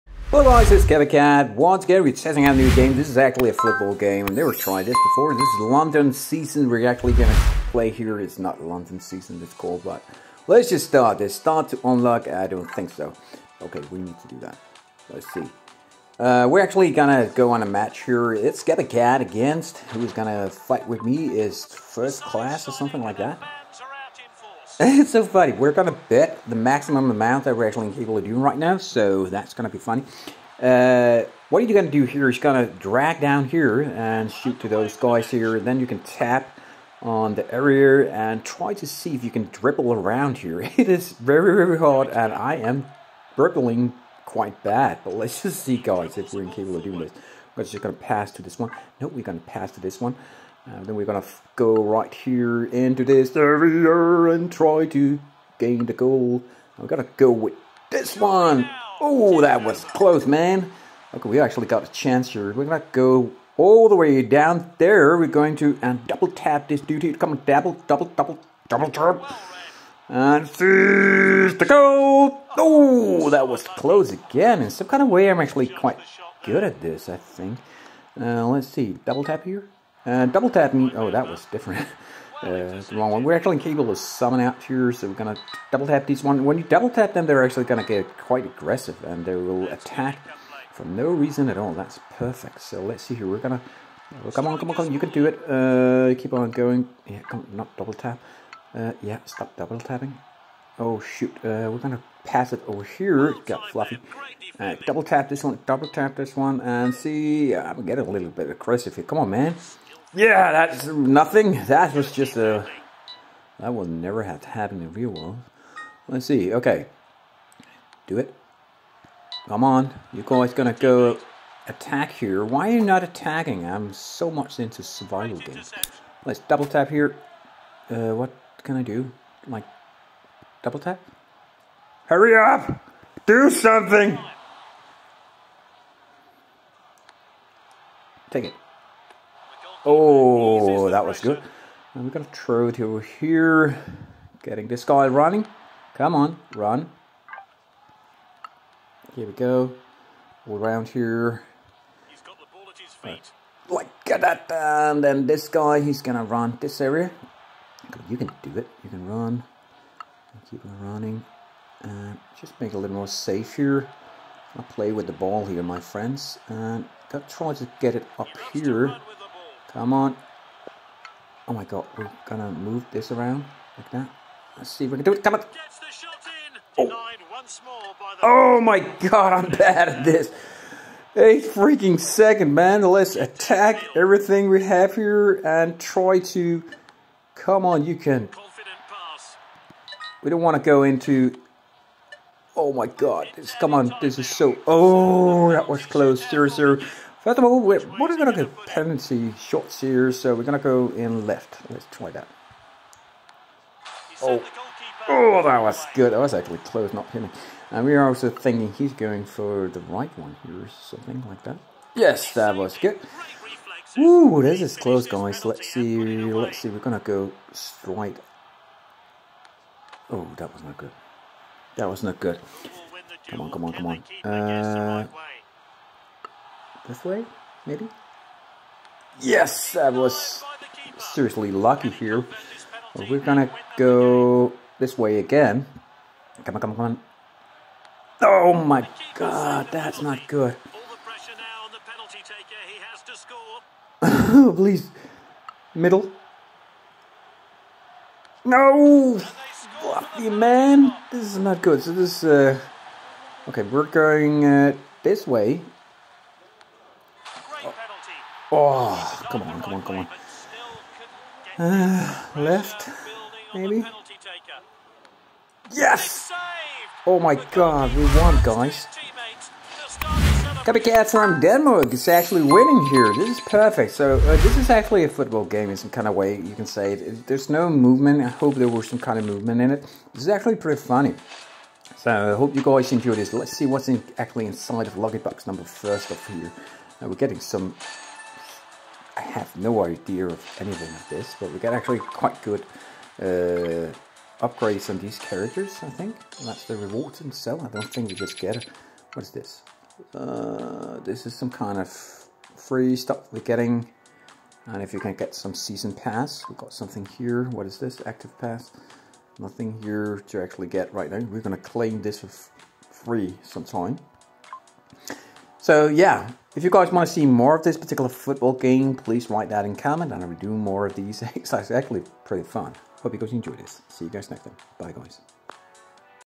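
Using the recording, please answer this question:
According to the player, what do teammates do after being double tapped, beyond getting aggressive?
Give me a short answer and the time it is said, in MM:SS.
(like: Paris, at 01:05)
attack for no reason, at 01:29.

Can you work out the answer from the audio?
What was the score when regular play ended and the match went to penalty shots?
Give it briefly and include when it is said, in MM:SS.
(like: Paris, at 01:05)
0-0, at 03:16.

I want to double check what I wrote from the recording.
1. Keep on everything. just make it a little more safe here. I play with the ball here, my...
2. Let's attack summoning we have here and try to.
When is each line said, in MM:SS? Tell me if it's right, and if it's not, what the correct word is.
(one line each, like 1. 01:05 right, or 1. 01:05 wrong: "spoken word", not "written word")
1. 02:40 wrong: "running", not "everything"
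2. 03:02 wrong: "everything", not "summoning".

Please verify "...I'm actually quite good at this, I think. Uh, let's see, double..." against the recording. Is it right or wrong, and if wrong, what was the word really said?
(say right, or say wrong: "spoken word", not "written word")
right.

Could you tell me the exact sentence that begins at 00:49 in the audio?
No, we're going to pass to this one.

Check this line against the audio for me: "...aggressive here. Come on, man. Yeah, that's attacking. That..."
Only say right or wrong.
wrong.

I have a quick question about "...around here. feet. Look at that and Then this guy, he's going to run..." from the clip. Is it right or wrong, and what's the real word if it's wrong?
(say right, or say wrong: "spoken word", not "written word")
right.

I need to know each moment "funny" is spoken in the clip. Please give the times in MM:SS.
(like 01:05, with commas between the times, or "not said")
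00:25, 00:29, 04:40.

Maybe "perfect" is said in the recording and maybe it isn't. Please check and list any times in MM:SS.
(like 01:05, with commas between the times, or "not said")
01:32, 04:33.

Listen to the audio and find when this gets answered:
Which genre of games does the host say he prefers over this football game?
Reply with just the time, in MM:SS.
02:04.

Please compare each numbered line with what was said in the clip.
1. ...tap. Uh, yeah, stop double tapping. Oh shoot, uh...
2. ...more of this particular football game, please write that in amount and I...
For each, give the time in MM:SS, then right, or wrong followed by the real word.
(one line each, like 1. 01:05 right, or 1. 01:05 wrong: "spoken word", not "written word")
1. 01:37 right
2. 05:17 wrong: "comment", not "amount".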